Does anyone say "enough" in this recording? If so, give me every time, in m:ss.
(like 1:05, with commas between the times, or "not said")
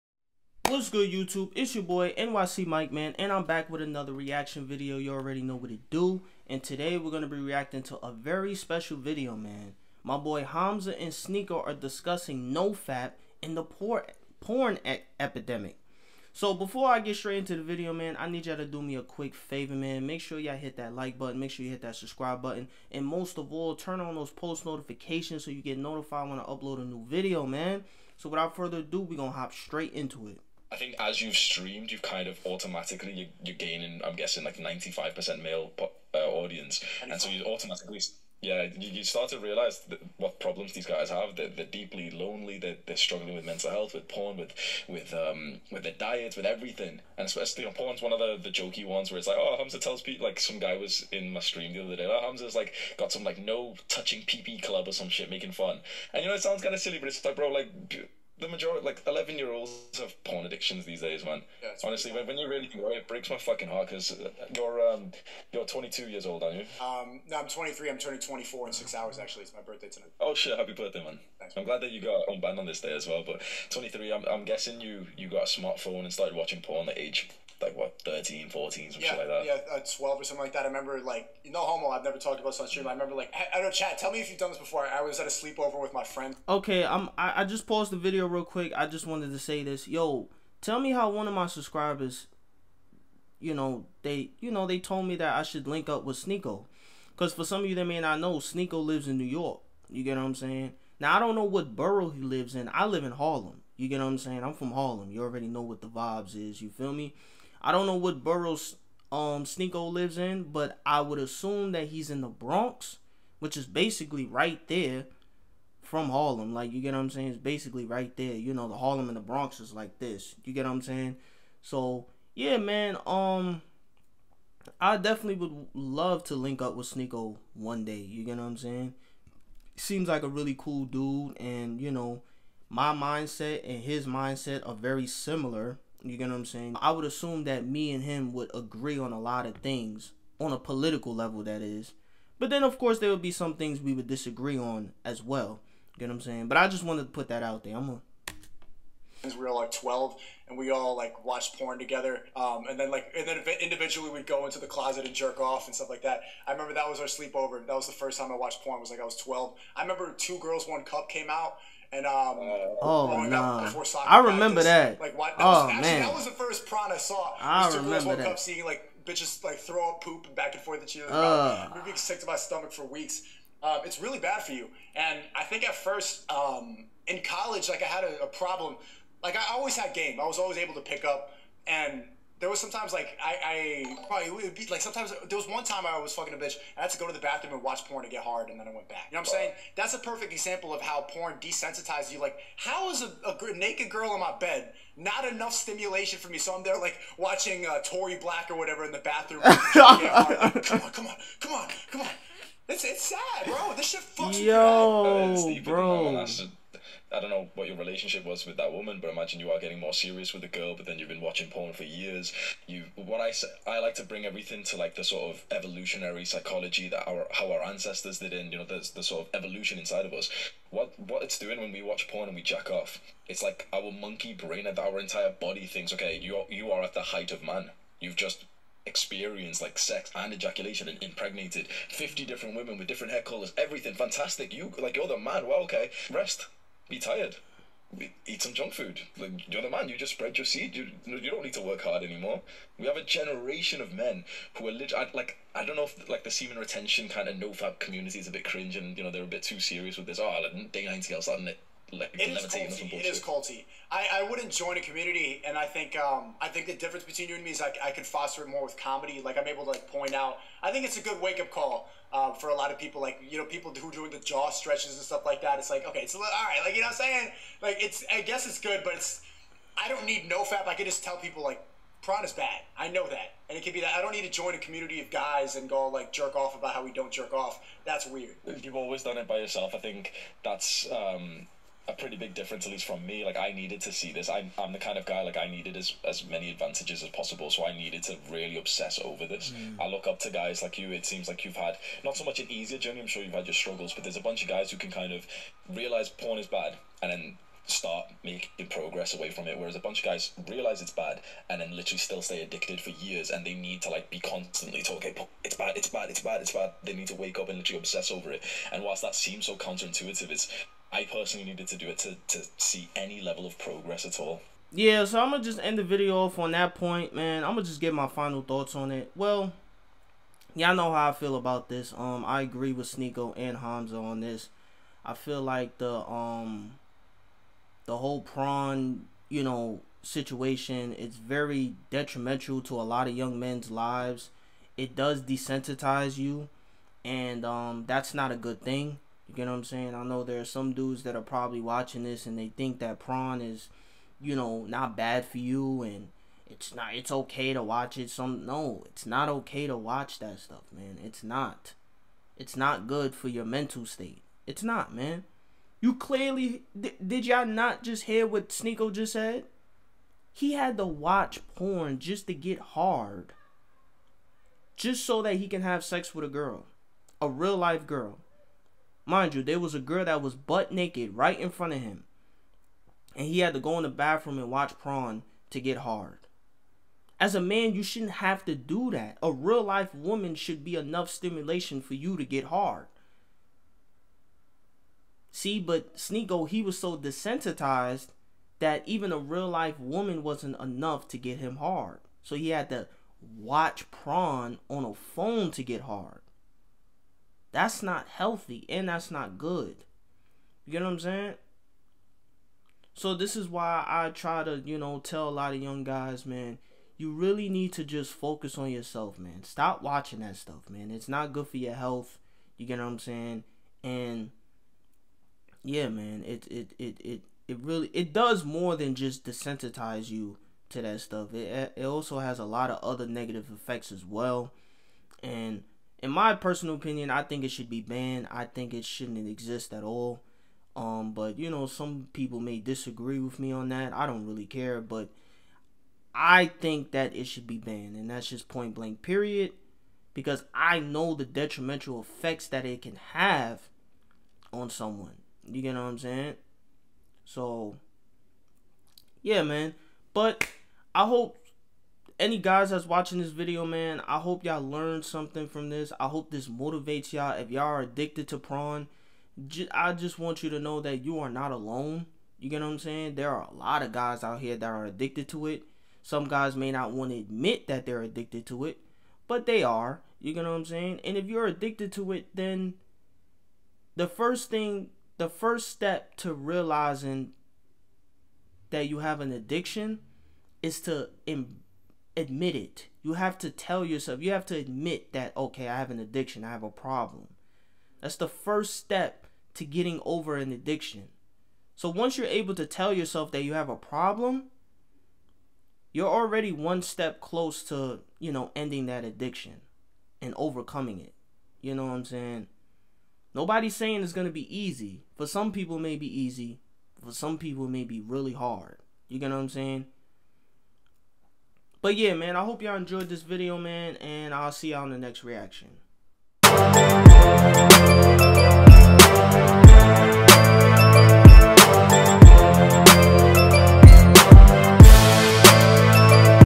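3:15, 6:20, 6:30.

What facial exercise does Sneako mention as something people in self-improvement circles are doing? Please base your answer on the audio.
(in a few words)
Jaw stretches.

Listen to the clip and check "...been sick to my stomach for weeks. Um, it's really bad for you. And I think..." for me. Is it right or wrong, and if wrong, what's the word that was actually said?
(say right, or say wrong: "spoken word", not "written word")
right.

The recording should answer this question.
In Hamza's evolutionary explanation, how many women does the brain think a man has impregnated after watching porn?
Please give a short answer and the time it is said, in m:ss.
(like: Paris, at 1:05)
50, at 3:51.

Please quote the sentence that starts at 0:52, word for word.
Oh Hamza's like got some like no touching PP club or some shit making fun.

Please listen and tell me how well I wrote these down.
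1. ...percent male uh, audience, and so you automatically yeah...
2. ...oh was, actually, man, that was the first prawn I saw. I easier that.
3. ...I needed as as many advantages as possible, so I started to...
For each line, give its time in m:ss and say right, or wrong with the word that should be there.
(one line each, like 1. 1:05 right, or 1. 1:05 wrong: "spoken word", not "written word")
1. 0:35 right
2. 2:45 wrong: "remember", not "easier"
3. 4:45 wrong: "needed", not "started".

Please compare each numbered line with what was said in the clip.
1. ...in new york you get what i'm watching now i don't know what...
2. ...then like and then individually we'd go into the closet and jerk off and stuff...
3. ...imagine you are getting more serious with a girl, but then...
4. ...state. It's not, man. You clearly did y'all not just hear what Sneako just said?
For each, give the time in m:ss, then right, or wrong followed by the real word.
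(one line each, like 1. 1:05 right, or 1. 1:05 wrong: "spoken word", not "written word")
1. 1:39 wrong: "saying", not "watching"
2. 2:32 right
3. 3:29 right
4. 5:53 right.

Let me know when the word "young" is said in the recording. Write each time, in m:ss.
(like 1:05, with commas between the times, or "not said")
5:33, 6:45.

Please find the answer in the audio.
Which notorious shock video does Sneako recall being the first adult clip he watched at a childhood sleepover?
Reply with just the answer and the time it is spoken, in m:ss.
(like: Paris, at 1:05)
Two Girls One Cup, at 2:40.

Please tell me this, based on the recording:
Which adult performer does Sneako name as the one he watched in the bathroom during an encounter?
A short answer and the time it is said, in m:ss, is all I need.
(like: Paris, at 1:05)
Tori Black, at 3:17.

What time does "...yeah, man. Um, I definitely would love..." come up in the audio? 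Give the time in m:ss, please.
2:02.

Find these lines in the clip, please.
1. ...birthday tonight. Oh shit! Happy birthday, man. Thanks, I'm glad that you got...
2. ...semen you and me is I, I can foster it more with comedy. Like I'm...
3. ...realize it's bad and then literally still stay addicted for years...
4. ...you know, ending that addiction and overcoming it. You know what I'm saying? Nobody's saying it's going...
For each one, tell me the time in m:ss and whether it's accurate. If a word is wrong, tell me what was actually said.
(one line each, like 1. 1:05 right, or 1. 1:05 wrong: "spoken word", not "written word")
1. 1:09 right
2. 4:17 wrong: "between", not "semen"
3. 5:00 right
4. 8:18 right.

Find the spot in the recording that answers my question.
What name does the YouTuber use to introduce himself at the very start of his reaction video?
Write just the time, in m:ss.
0:02.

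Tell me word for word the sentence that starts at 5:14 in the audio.
Yeah, so I'm gonna just end the video off on that point, man.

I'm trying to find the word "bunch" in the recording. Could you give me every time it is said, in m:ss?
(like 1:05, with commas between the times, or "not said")
4:54, 4:59.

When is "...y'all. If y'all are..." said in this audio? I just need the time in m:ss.
7:37.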